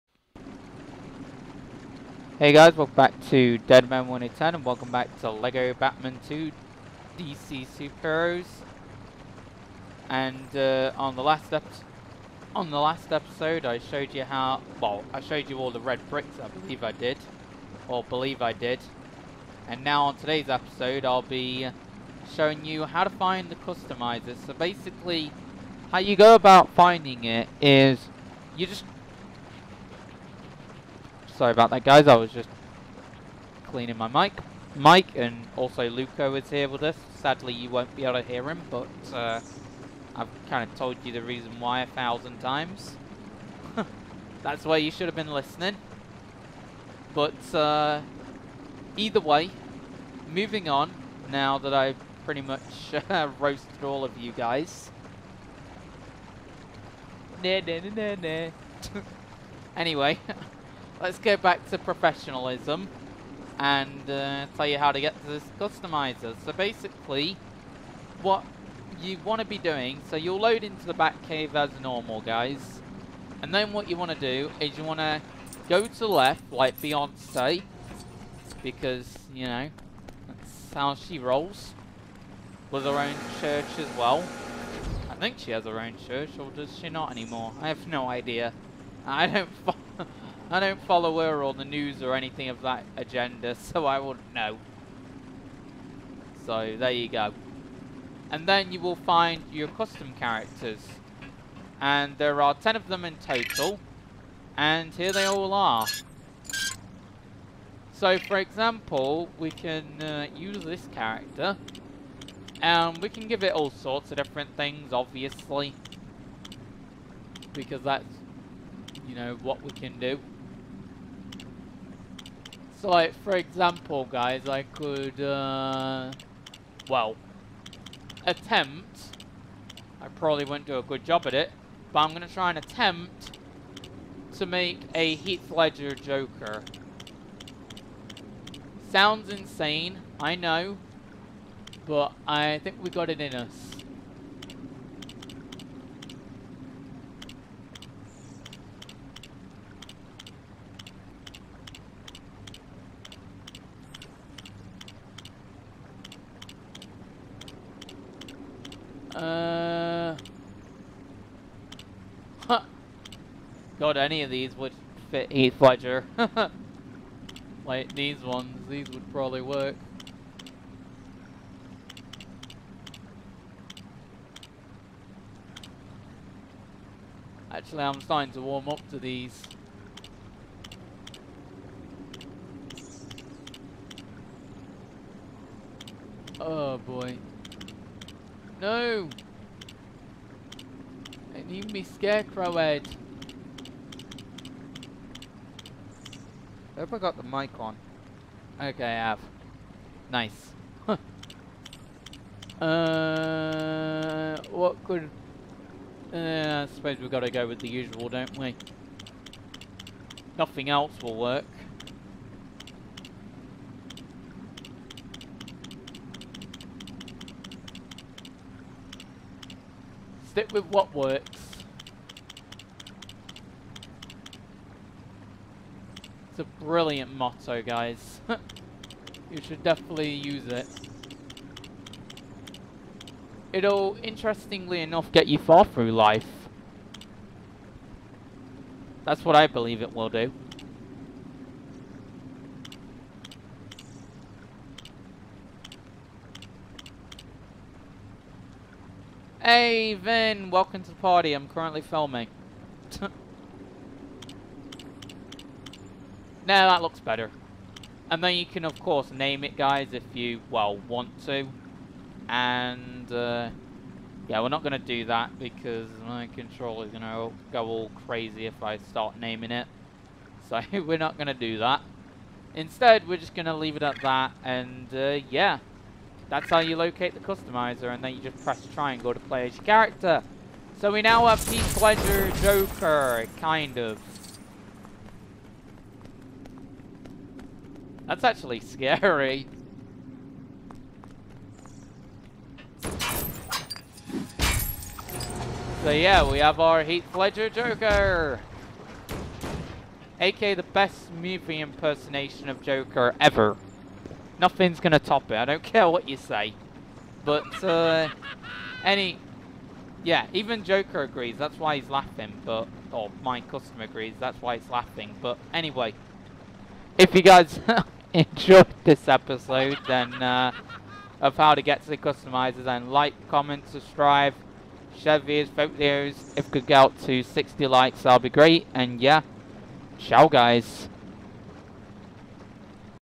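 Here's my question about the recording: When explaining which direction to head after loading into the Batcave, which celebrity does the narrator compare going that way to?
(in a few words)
Beyonce.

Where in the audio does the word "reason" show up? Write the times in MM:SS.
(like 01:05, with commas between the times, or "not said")
00:41.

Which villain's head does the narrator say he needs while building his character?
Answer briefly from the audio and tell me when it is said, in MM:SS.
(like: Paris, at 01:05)
Scarecrow, at 03:11.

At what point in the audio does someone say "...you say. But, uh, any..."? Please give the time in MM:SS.
05:06.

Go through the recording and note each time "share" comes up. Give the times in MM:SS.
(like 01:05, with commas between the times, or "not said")
05:24.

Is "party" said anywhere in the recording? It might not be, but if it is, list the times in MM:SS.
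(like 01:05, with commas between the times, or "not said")
04:10.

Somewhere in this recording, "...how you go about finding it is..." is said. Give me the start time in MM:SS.
00:25.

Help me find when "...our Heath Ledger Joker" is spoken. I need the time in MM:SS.
04:56.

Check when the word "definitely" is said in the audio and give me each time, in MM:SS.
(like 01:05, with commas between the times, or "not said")
03:49.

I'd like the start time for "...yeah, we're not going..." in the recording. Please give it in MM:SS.
04:24.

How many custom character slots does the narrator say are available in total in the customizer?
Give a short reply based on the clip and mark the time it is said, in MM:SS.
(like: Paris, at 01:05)
10, at 01:42.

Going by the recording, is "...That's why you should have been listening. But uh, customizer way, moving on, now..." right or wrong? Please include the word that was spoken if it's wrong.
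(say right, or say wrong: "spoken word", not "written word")
wrong: "either", not "customizer".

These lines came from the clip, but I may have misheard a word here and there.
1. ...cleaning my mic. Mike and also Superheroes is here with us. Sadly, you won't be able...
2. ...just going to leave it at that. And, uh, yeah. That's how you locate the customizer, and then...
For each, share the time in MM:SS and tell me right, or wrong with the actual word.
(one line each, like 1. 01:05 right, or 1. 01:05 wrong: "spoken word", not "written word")
1. 00:33 wrong: "Luco", not "Superheroes"
2. 04:33 right.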